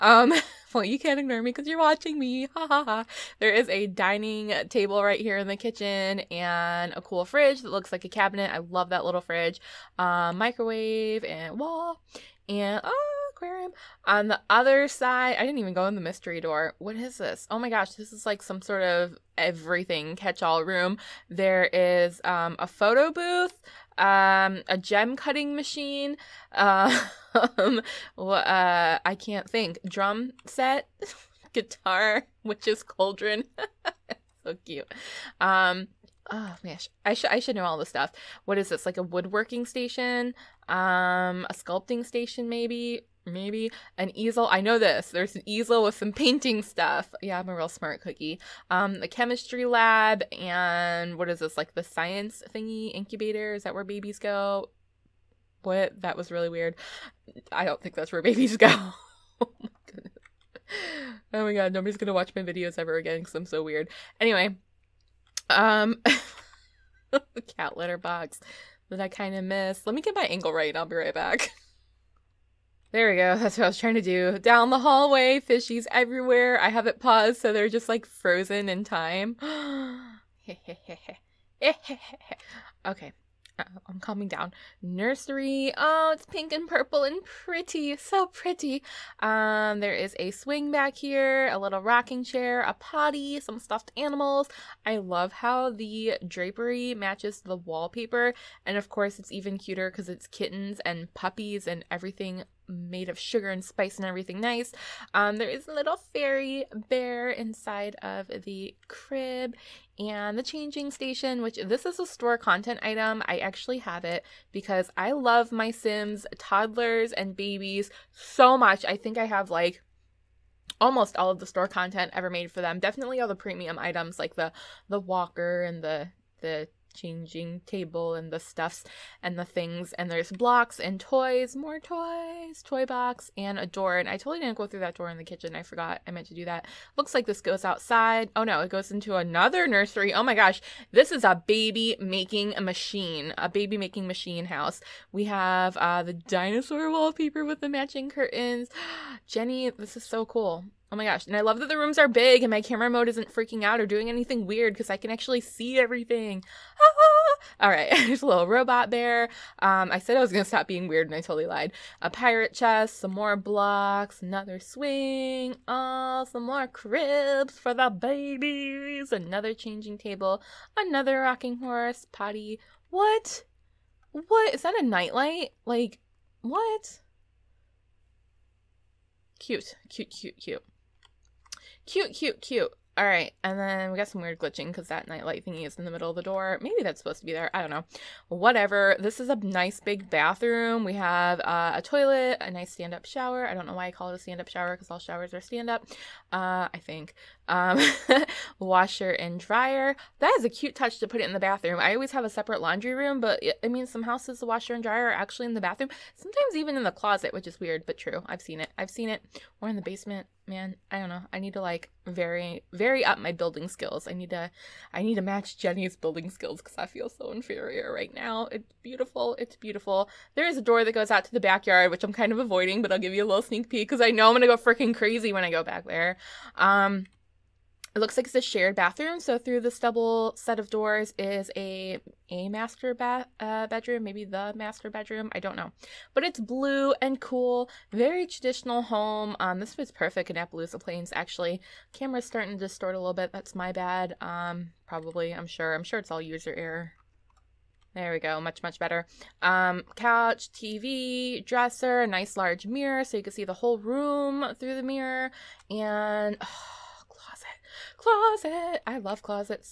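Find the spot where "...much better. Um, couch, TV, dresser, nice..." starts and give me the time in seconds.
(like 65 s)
248 s.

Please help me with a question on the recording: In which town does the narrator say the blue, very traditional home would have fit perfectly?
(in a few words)
Appaloosa Plains.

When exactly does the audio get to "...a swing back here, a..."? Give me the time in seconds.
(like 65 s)
90 s.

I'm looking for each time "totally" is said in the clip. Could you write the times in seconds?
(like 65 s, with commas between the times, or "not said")
134 s, 161 s.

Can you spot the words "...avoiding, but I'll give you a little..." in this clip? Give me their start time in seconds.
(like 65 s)
222 s.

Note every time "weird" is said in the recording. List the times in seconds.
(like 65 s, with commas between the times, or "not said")
56 s, 63 s, 154 s, 160 s, 184 s, 207 s.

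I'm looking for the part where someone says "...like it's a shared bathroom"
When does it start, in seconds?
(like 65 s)
228 s.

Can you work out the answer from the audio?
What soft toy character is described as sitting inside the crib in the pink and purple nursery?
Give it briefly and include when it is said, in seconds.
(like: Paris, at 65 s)
fairy bear, at 105 s.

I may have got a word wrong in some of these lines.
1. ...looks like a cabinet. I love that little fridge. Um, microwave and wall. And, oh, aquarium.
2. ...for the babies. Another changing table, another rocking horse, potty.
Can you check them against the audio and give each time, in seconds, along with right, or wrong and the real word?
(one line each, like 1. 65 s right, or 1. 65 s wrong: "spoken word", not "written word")
1. 7 s right
2. 167 s right.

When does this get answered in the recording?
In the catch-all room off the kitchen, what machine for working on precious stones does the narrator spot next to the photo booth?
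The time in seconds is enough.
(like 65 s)
24 s.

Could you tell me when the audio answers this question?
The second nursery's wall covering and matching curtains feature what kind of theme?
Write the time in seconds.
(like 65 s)
146 s.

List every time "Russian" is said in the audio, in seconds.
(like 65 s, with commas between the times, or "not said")
not said.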